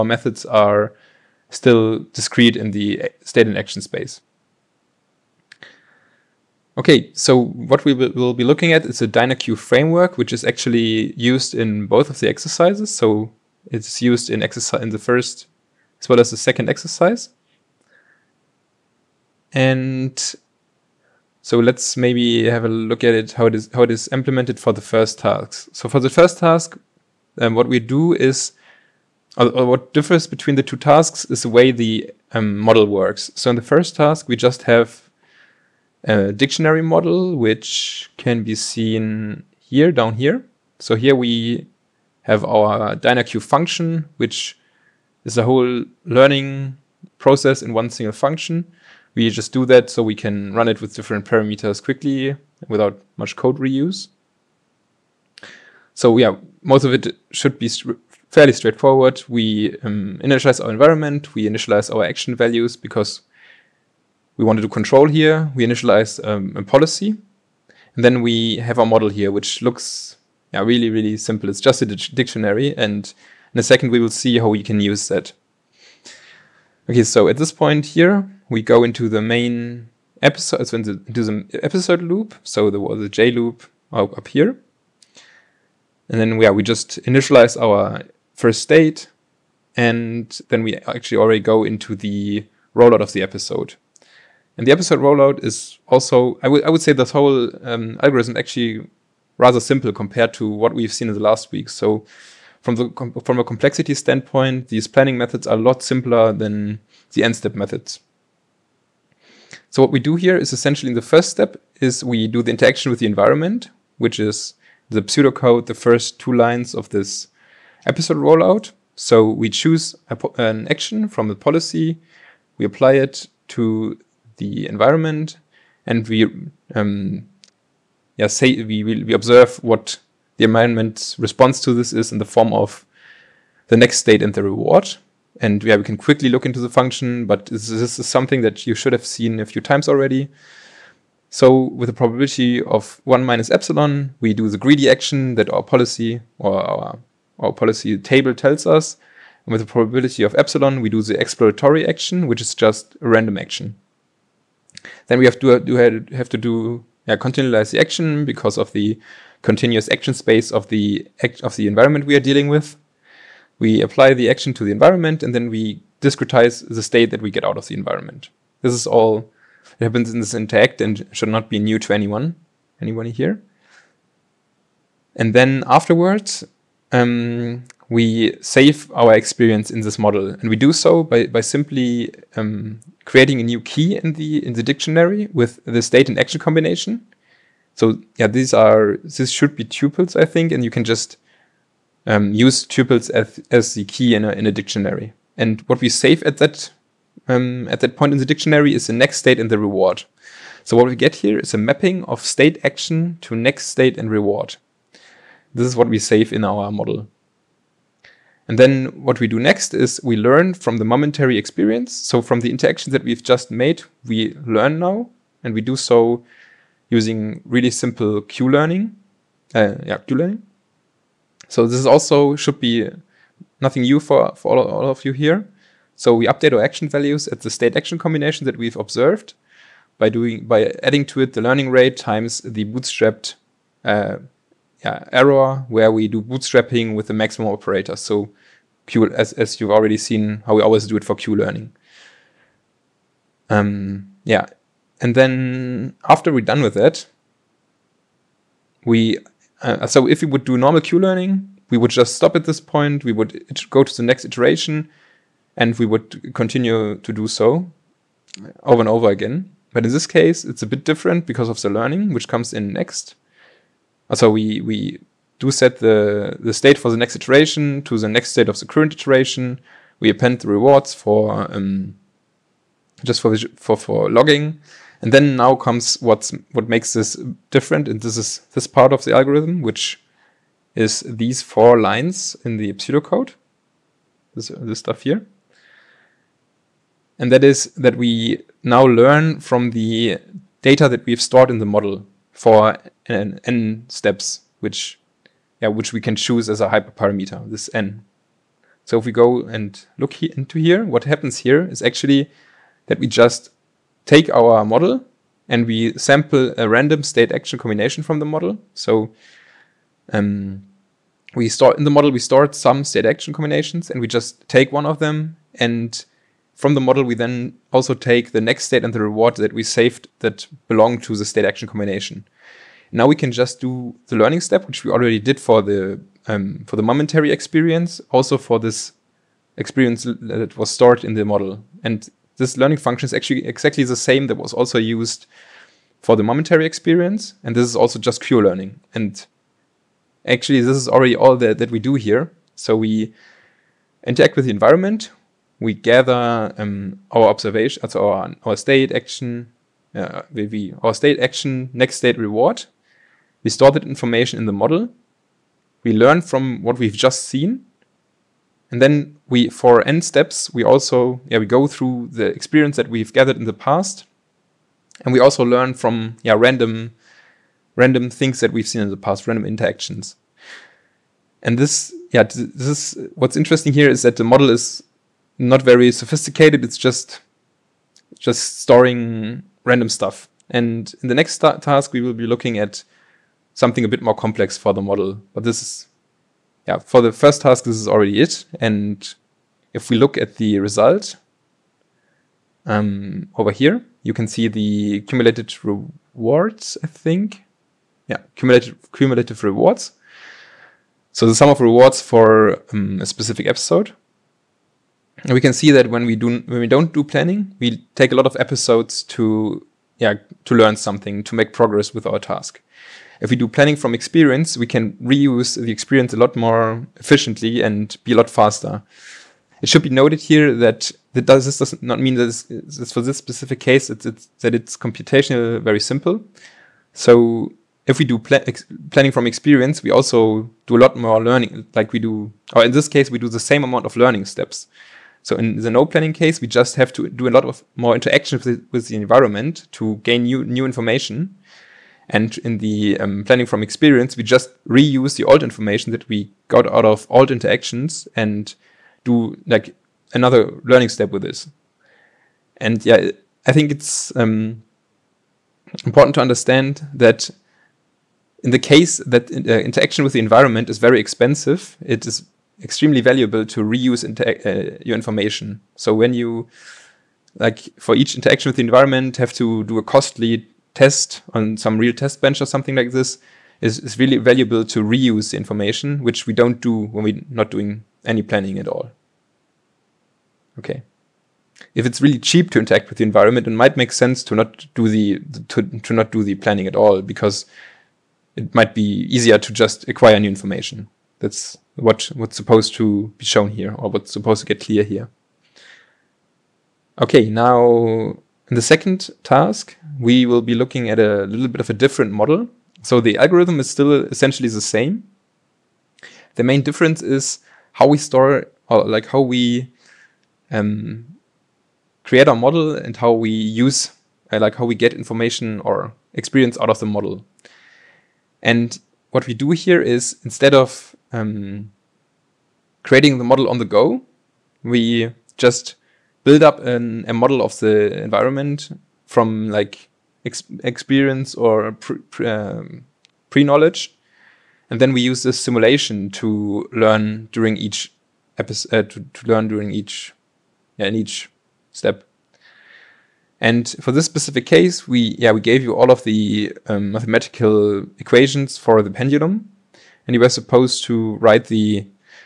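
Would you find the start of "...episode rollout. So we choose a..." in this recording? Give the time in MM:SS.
01:57.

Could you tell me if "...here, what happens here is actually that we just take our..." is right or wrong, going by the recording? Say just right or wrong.
right.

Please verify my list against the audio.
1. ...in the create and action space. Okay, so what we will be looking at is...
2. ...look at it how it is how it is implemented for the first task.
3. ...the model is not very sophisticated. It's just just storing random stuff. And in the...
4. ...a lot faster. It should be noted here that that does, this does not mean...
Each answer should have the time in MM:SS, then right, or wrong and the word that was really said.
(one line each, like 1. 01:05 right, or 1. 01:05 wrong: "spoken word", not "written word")
1. 00:02 wrong: "state", not "create"
2. 00:22 right
3. 06:14 right
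4. 06:58 right.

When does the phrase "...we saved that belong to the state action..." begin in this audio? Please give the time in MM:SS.
05:19.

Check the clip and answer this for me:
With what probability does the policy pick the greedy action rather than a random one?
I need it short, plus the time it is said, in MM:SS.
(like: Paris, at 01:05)
1 minus epsilon, at 02:23.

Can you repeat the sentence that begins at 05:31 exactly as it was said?
And this learning function is actually exactly the same that was also used for the momentary experience.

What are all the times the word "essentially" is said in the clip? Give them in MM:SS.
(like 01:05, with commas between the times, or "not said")
01:50, 08:24.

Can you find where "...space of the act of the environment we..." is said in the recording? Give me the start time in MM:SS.
02:40.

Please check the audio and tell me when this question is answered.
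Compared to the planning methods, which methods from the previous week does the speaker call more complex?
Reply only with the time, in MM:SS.
01:47.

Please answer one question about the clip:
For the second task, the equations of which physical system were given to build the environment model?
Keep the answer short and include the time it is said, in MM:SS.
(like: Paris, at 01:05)
pendulum, at 09:08.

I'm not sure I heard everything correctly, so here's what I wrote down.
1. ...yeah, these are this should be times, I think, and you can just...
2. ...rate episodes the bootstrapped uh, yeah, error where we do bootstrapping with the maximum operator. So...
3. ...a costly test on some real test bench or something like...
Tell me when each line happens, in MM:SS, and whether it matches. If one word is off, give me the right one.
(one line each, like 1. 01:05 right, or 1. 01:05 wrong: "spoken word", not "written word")
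1. 03:08 wrong: "tuples", not "times"
2. 03:51 wrong: "times", not "episodes"
3. 07:49 right.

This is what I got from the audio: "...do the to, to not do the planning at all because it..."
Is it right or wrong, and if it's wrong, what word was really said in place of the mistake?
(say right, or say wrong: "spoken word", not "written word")
right.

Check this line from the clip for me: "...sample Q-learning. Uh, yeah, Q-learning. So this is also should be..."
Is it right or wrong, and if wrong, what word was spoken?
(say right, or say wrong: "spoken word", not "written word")
wrong: "simple", not "sample".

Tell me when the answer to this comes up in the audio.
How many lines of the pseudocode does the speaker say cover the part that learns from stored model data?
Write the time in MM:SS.
04:41.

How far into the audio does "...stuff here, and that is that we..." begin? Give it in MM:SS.
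04:44.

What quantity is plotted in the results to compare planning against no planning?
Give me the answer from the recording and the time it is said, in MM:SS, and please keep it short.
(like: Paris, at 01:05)
cumulative rewards, at 06:38.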